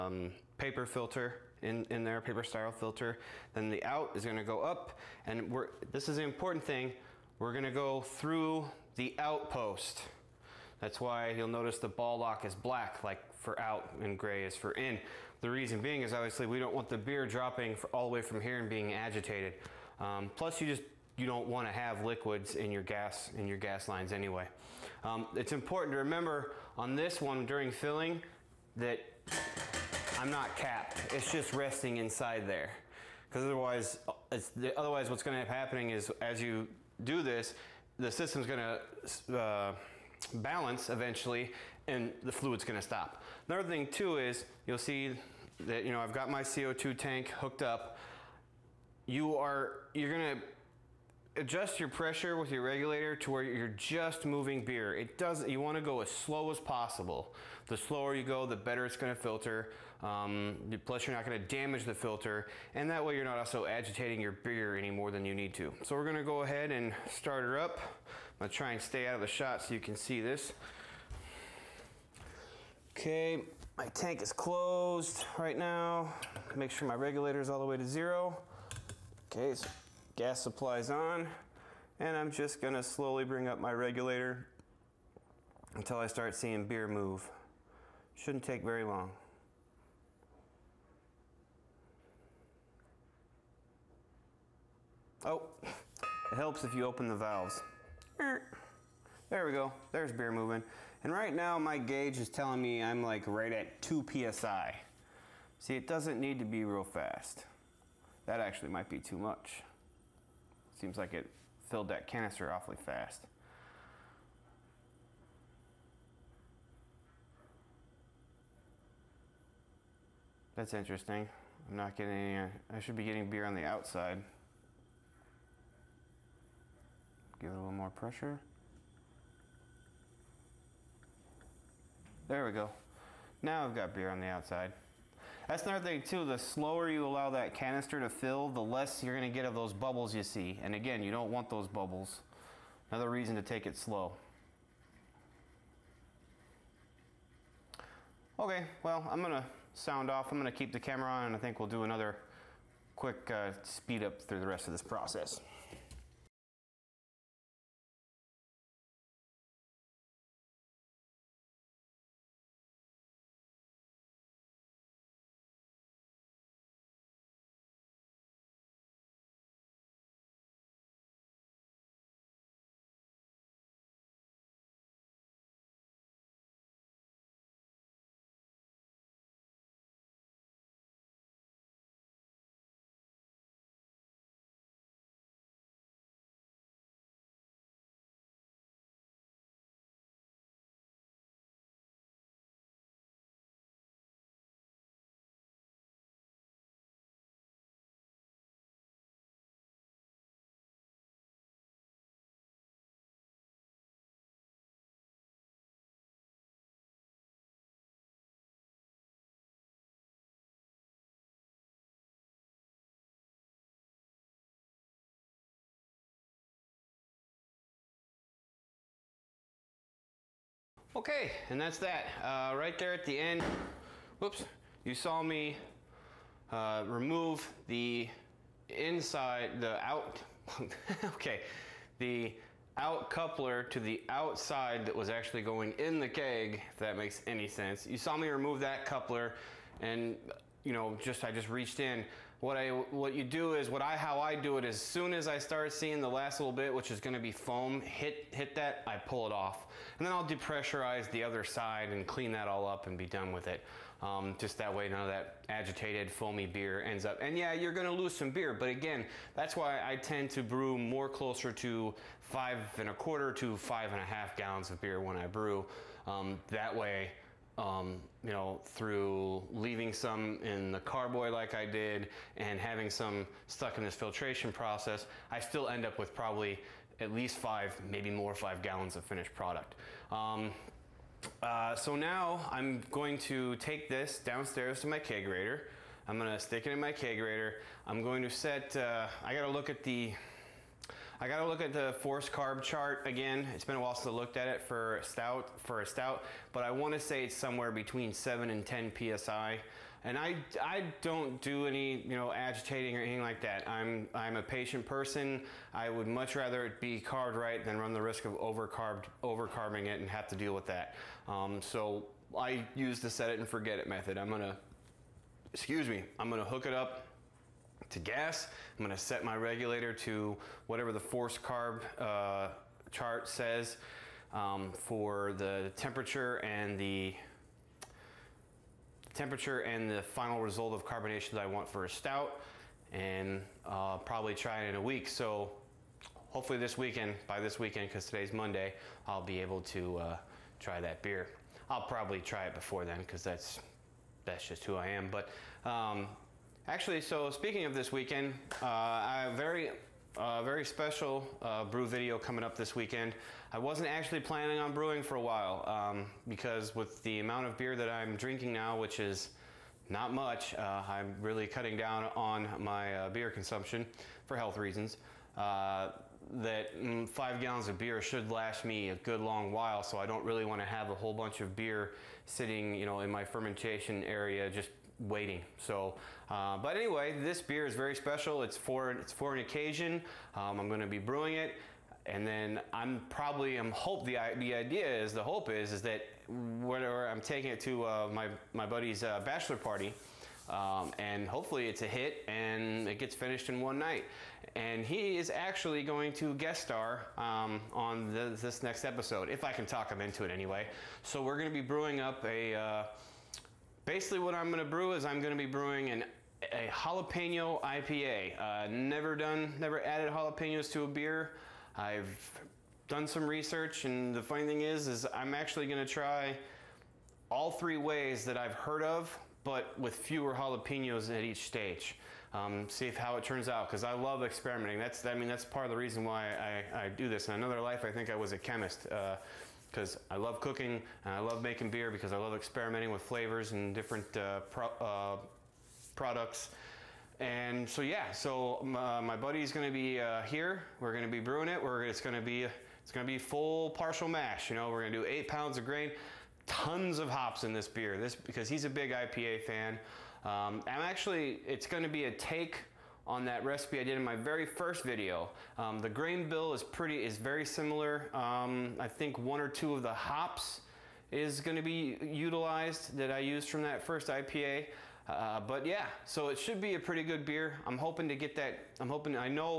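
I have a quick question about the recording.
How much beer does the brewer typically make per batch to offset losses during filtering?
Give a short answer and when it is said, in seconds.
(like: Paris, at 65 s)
5.25 to 5.5 gallons, at 262 s.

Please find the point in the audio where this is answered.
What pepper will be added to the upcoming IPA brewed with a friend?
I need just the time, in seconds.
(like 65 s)
406 s.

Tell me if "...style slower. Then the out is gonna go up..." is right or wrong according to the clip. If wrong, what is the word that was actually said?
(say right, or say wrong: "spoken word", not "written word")
wrong: "filter", not "slower".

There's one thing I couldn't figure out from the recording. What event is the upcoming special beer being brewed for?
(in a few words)
Bachelor party.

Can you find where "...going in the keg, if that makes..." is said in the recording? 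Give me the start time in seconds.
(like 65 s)
235 s.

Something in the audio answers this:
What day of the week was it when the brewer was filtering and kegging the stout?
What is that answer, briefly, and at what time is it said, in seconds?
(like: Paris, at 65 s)
Monday, at 338 s.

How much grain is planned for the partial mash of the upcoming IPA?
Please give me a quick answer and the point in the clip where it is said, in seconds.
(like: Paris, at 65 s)
8 pounds, at 445 s.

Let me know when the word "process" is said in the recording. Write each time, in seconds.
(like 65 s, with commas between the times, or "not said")
154 s, 274 s.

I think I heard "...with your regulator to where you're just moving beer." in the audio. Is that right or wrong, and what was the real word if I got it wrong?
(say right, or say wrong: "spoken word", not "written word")
right.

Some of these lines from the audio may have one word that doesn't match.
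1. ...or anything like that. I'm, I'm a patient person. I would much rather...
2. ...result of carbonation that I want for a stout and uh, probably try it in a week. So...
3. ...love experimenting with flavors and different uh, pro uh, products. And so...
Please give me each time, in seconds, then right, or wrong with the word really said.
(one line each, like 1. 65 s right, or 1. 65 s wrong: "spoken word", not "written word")
1. 302 s right
2. 330 s right
3. 432 s right.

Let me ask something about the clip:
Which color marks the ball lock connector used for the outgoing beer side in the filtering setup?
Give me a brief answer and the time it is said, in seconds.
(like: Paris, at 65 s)
Black, at 12 s.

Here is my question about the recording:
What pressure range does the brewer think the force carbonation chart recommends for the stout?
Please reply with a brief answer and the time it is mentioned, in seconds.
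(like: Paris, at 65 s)
7 to 10 PSI, at 298 s.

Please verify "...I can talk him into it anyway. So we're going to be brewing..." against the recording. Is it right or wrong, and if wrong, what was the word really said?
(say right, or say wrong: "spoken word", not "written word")
right.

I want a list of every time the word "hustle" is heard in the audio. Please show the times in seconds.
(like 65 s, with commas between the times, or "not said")
not said.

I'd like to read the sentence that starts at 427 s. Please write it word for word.
In another life, I think I was a chemist.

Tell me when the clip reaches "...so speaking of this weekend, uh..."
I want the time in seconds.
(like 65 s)
347 s.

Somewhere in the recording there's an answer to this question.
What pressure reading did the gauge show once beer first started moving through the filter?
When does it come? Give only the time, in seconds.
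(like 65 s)
103 s.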